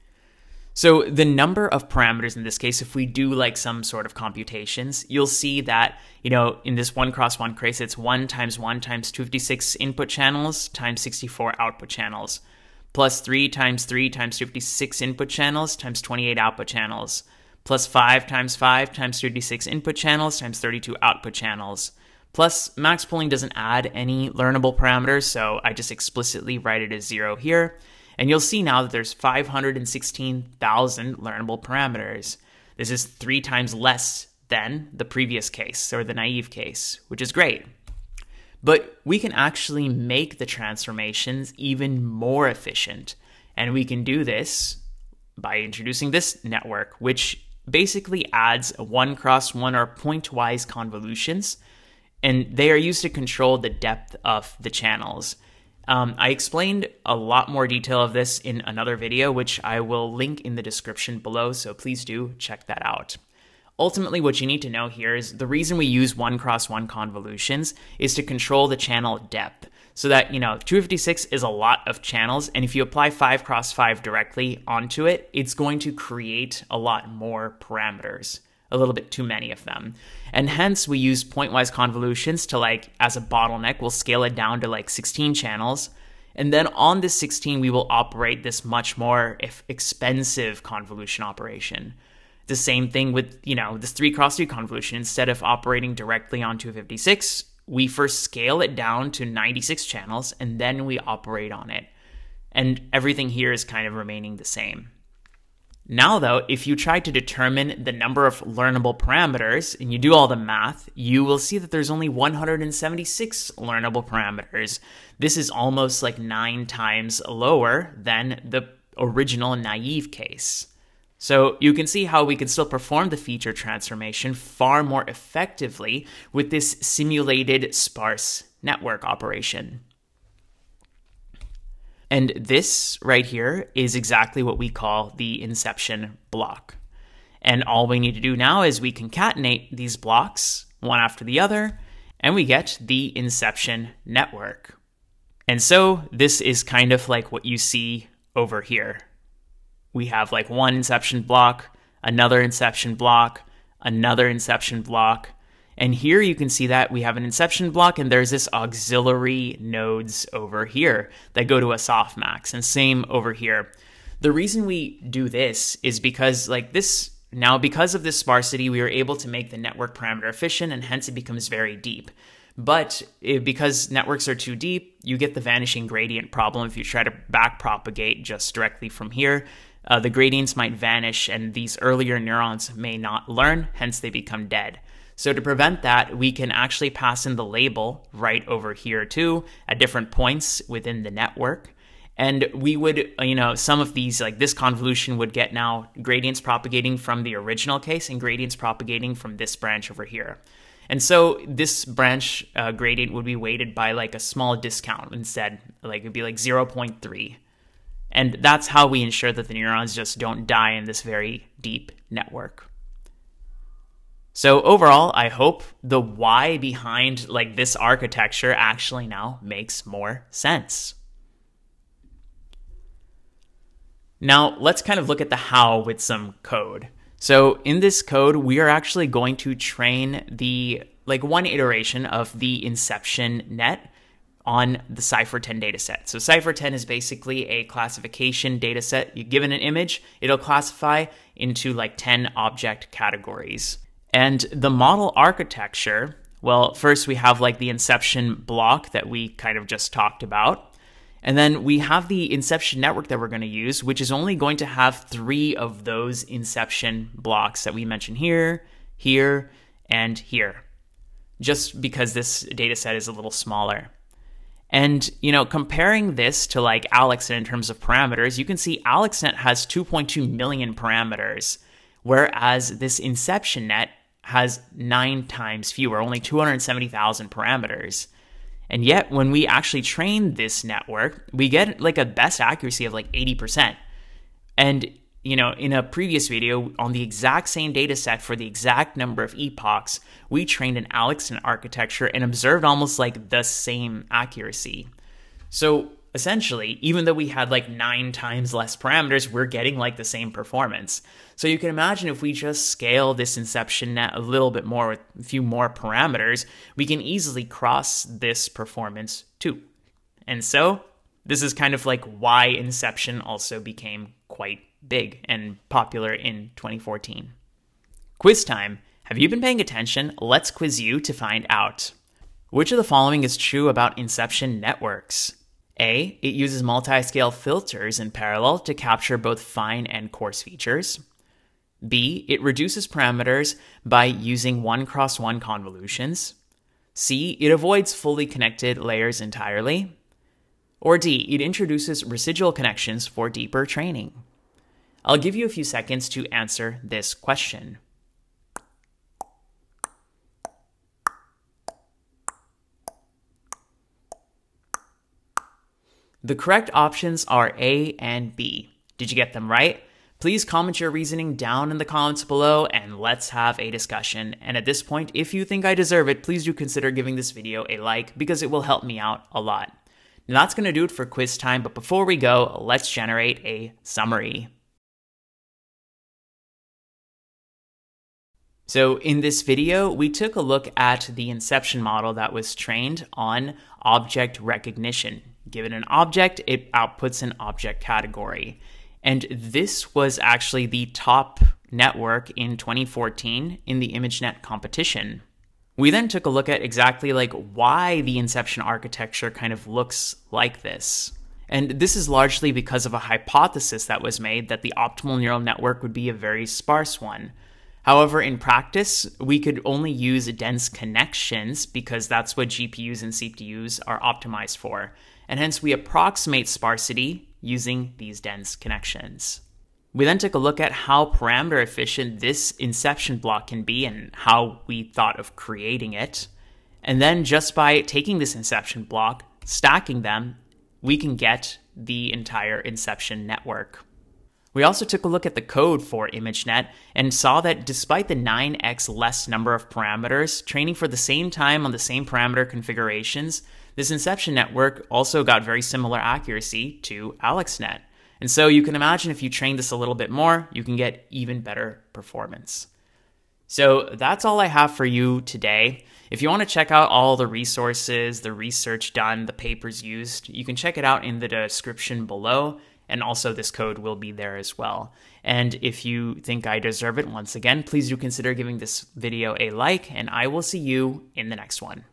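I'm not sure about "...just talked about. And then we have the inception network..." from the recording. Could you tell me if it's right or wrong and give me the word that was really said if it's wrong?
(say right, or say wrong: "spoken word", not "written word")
right.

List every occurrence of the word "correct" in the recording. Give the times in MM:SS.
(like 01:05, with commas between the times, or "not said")
05:56.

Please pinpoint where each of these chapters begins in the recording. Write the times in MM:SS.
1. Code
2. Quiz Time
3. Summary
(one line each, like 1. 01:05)
1. 03:41
2. 05:17
3. 06:14.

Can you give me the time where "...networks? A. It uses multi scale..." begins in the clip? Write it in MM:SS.
05:24.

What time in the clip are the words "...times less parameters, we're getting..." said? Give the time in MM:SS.
04:58.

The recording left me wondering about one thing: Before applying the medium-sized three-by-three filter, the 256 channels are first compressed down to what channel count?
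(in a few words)
96.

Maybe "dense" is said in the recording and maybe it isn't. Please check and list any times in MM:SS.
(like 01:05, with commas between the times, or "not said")
06:50, 06:58.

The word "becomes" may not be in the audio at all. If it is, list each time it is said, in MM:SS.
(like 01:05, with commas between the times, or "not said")
02:51, 03:04.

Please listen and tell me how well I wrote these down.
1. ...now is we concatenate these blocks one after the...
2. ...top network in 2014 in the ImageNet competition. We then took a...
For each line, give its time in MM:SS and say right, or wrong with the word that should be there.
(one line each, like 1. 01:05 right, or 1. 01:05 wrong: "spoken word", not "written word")
1. 02:18 right
2. 06:30 right.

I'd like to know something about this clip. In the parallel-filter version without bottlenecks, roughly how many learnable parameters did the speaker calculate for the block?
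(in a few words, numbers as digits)
516,000.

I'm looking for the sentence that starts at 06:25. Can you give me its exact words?
Given an object, it outputs an object category.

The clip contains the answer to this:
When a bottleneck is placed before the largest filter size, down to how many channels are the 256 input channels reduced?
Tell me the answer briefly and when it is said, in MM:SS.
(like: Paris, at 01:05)
16, at 01:24.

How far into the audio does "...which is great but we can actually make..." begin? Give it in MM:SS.
00:37.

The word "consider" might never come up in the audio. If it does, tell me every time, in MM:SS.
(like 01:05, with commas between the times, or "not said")
06:06, 07:47.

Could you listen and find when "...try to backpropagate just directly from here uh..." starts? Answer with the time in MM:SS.
02:56.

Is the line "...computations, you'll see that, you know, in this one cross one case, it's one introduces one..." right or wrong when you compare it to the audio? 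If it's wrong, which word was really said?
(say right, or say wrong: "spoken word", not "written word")
wrong: "times", not "introduces".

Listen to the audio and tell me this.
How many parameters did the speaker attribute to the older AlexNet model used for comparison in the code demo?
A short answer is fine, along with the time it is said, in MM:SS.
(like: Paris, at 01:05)
2.2 million, at 04:29.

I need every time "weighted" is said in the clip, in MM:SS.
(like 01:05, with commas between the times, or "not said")
03:23.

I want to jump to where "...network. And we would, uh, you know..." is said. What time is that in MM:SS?
03:11.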